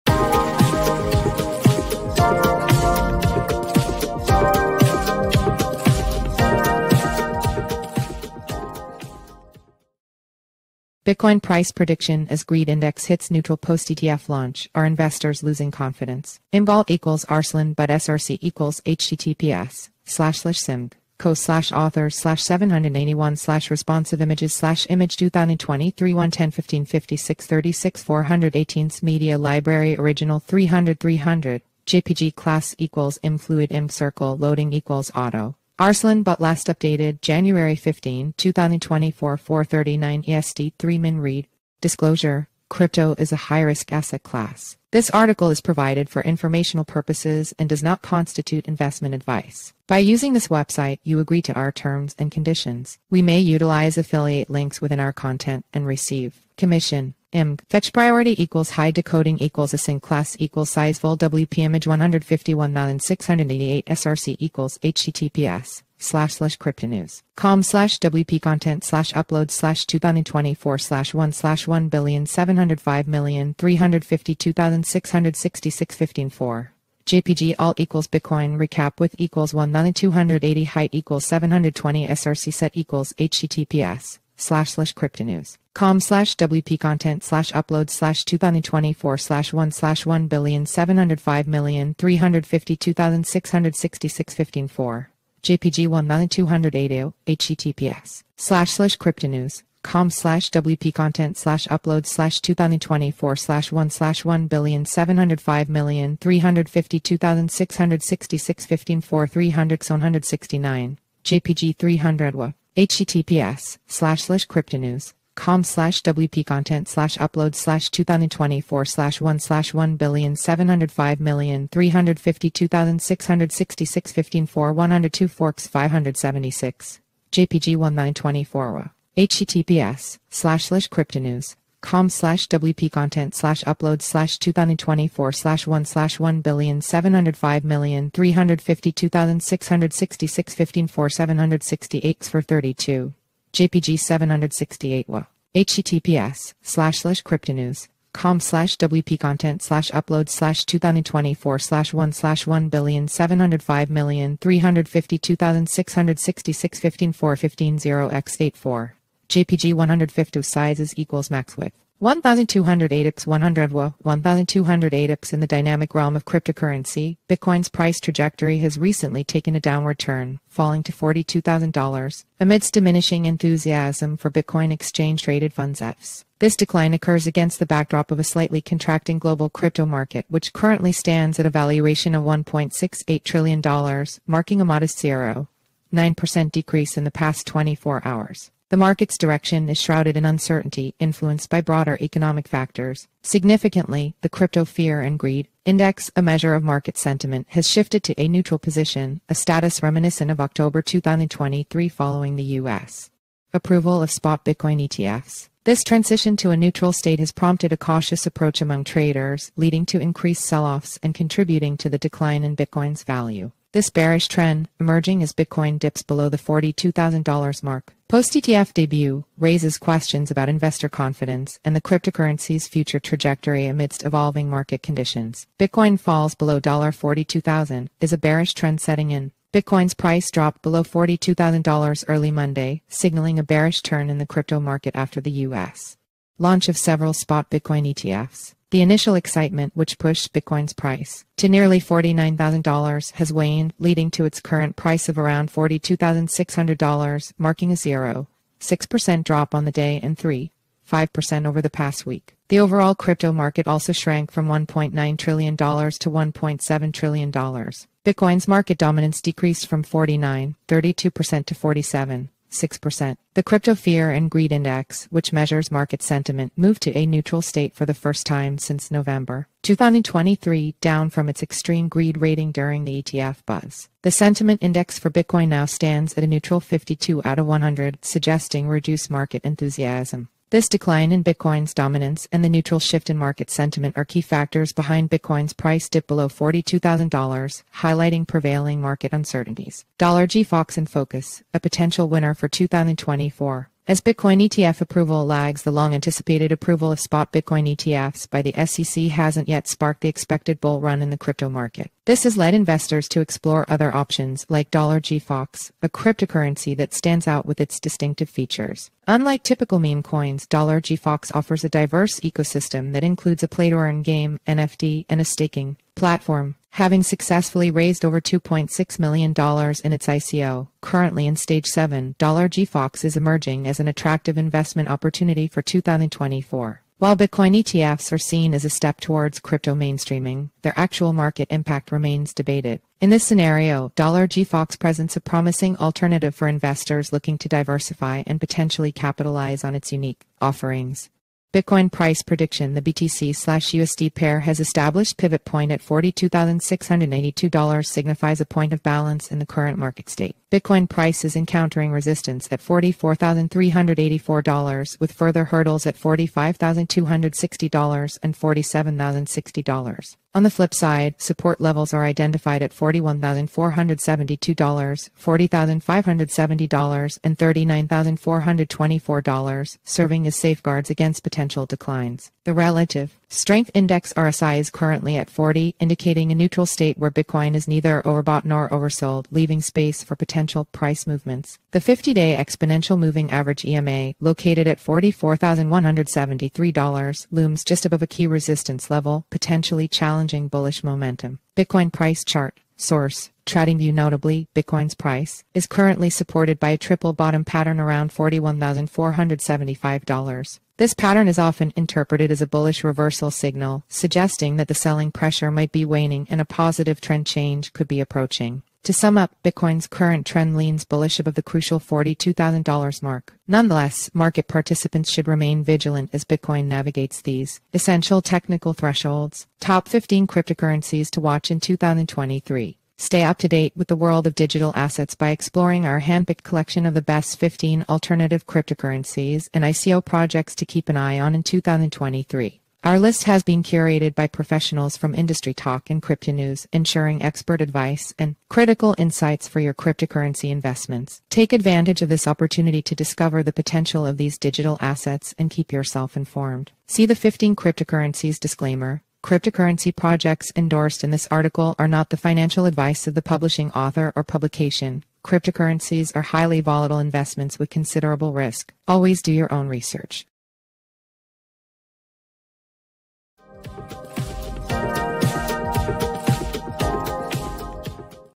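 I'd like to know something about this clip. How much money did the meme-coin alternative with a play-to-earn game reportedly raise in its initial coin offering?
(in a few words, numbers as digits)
over $2.6 million.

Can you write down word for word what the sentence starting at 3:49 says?
Bitcoin's price dropped below $42,000 early Monday, signaling a bearish turn in the crypto market after the U.S.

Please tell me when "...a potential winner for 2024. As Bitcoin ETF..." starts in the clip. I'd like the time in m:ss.
4:51.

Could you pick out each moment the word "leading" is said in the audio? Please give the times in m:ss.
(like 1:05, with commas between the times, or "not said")
3:29, 4:03.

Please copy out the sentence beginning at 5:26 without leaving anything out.
While Bitcoin ETFs are seen as a step towards crypto mainstreaming, their actual market impact remains debated.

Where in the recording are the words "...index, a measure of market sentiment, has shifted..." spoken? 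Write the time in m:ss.
3:15.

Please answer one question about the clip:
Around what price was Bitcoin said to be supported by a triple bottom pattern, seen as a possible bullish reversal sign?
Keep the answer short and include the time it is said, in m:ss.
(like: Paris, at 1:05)
$41,475, at 6:38.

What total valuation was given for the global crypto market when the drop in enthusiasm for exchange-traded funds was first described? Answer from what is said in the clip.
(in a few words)
$1.68 trillion.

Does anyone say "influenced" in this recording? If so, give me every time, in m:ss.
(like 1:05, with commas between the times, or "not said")
3:10.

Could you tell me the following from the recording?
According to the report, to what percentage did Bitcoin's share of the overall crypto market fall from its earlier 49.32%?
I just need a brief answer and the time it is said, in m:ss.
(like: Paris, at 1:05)
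47.6%, at 4:21.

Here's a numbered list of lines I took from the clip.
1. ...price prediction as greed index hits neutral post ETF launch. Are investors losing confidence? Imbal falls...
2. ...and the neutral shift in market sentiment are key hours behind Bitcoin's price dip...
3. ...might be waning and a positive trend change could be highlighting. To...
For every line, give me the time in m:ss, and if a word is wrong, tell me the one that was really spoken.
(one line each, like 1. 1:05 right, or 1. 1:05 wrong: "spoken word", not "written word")
1. 0:11 wrong: "equals", not "falls"
2. 4:42 wrong: "factors", not "hours"
3. 6:45 wrong: "approaching", not "highlighting".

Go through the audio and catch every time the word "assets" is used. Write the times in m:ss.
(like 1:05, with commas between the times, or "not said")
0:43, 7:04, 7:24.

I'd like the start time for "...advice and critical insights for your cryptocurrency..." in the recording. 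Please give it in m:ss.
7:17.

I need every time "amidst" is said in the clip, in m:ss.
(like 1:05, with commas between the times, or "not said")
2:52, 3:43.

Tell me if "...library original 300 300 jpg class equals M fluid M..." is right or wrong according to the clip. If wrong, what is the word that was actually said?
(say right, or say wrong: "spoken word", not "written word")
right.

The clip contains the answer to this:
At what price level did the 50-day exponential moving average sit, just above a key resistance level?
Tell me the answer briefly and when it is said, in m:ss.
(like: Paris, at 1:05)
$44,173, at 6:24.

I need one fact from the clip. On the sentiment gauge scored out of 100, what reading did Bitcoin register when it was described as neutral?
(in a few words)
52.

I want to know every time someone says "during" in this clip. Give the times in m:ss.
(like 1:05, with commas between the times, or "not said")
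4:32.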